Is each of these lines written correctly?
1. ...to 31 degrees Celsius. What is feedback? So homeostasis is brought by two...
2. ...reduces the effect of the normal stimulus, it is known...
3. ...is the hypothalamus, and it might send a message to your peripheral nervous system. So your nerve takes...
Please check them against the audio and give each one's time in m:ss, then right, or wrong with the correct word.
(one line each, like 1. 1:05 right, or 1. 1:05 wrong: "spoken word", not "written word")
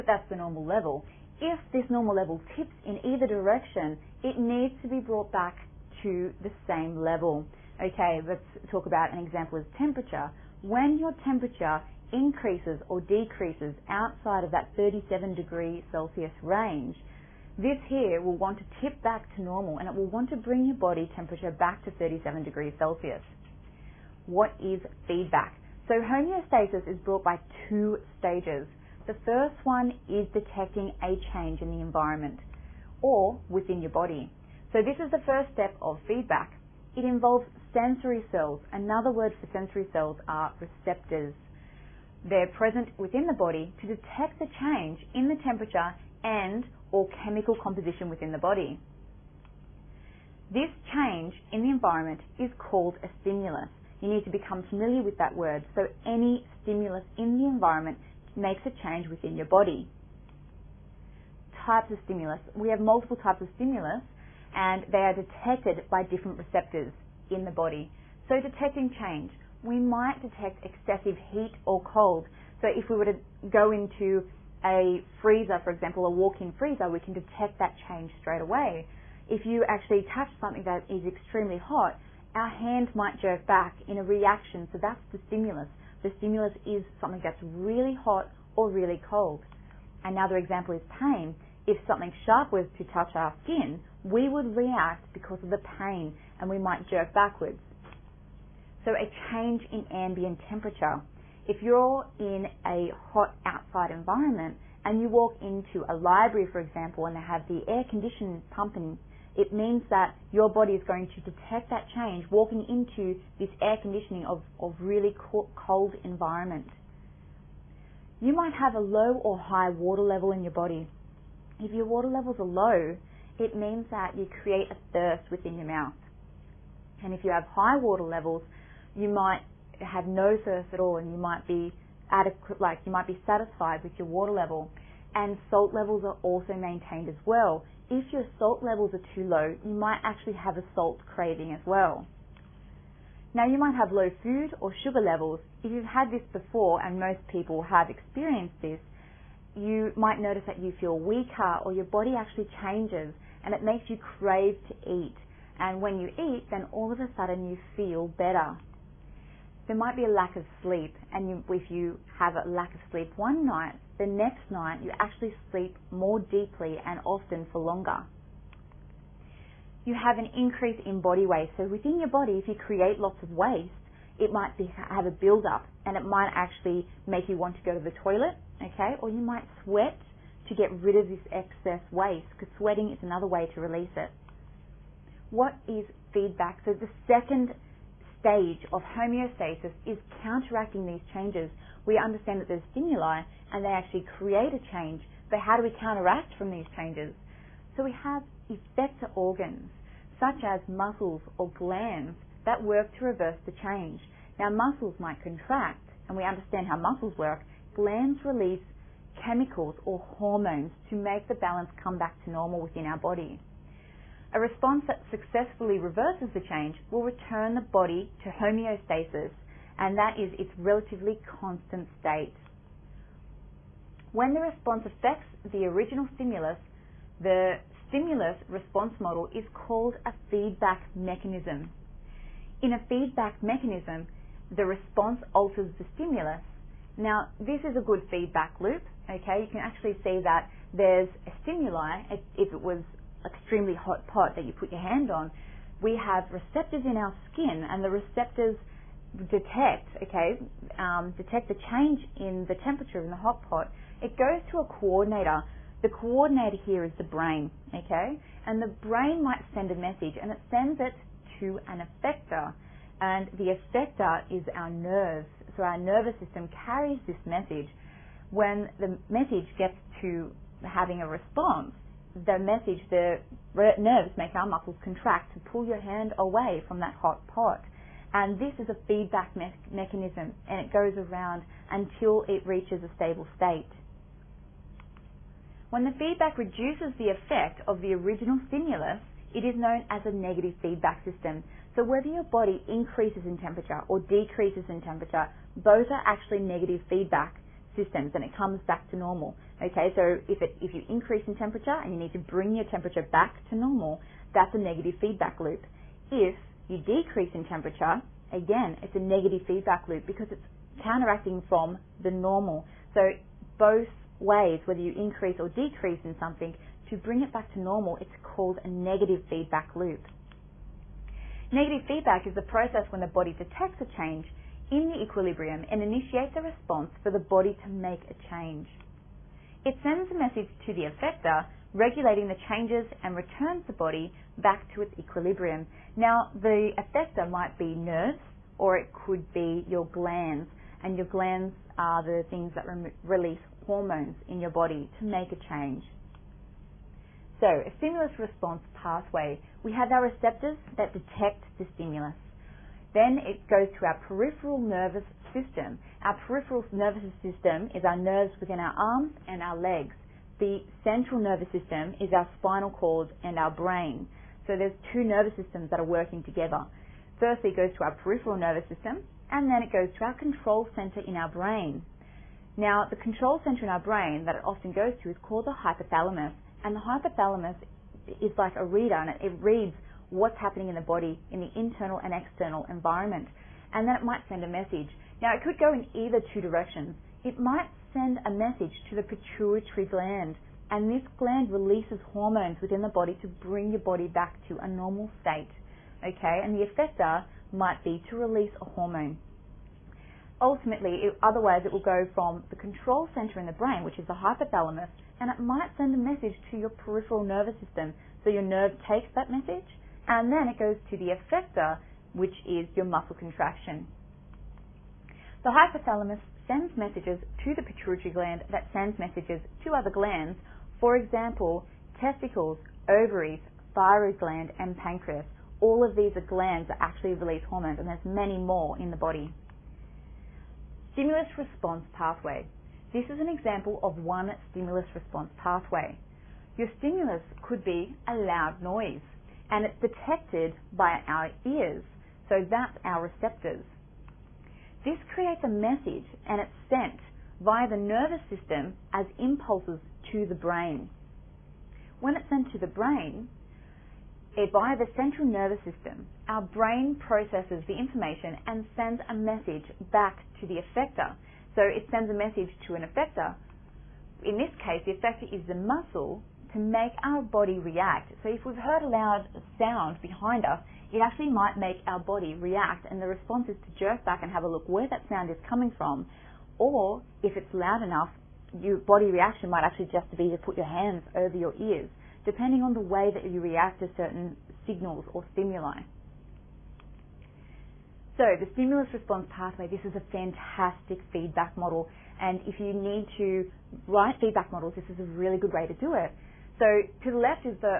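1. 0:21 wrong: "37", not "31"
2. 4:46 wrong: "original", not "normal"
3. 6:43 right.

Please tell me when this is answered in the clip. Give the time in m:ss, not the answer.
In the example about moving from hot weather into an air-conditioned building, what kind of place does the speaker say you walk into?
1:45.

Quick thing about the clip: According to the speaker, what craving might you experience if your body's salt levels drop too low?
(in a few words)
A salt craving.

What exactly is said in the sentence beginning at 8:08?
So the stimulus response pathway, this is a fantastic feedback model.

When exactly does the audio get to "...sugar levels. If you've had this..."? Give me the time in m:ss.
2:24.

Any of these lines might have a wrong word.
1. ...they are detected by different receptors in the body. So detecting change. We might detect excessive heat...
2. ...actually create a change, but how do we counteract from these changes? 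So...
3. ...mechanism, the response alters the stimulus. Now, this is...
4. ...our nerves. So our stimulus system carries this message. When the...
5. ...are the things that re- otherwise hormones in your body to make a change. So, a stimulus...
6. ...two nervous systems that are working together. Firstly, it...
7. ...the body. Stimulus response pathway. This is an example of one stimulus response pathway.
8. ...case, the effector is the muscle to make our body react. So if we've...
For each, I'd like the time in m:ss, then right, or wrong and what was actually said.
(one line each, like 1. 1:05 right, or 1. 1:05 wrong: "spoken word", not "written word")
1. 1:04 right
2. 3:13 right
3. 3:53 right
4. 4:24 wrong: "nervous", not "stimulus"
5. 5:41 wrong: "release", not "otherwise"
6. 6:04 right
7. 7:08 right
8. 7:44 right.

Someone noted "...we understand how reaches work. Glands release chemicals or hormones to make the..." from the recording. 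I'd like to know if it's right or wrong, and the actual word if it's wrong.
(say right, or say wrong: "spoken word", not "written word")
wrong: "muscles", not "reaches".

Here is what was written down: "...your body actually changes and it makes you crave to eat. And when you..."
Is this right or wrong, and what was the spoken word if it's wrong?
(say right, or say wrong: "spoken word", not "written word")
right.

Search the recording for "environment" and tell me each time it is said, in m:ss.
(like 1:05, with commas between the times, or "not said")
0:31, 0:51, 0:57, 1:43, 1:56, 6:22.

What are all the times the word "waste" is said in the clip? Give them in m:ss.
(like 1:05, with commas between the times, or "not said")
2:53, 3:01.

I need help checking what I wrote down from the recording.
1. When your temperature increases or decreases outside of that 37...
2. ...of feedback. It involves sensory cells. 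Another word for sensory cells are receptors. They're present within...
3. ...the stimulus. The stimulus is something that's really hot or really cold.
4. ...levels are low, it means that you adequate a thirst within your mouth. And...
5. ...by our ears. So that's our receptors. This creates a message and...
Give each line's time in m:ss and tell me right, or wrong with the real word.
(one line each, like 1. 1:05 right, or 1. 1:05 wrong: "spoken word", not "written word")
1. 0:10 right
2. 0:35 right
3. 1:25 right
4. 2:02 wrong: "create", not "adequate"
5. 7:20 right.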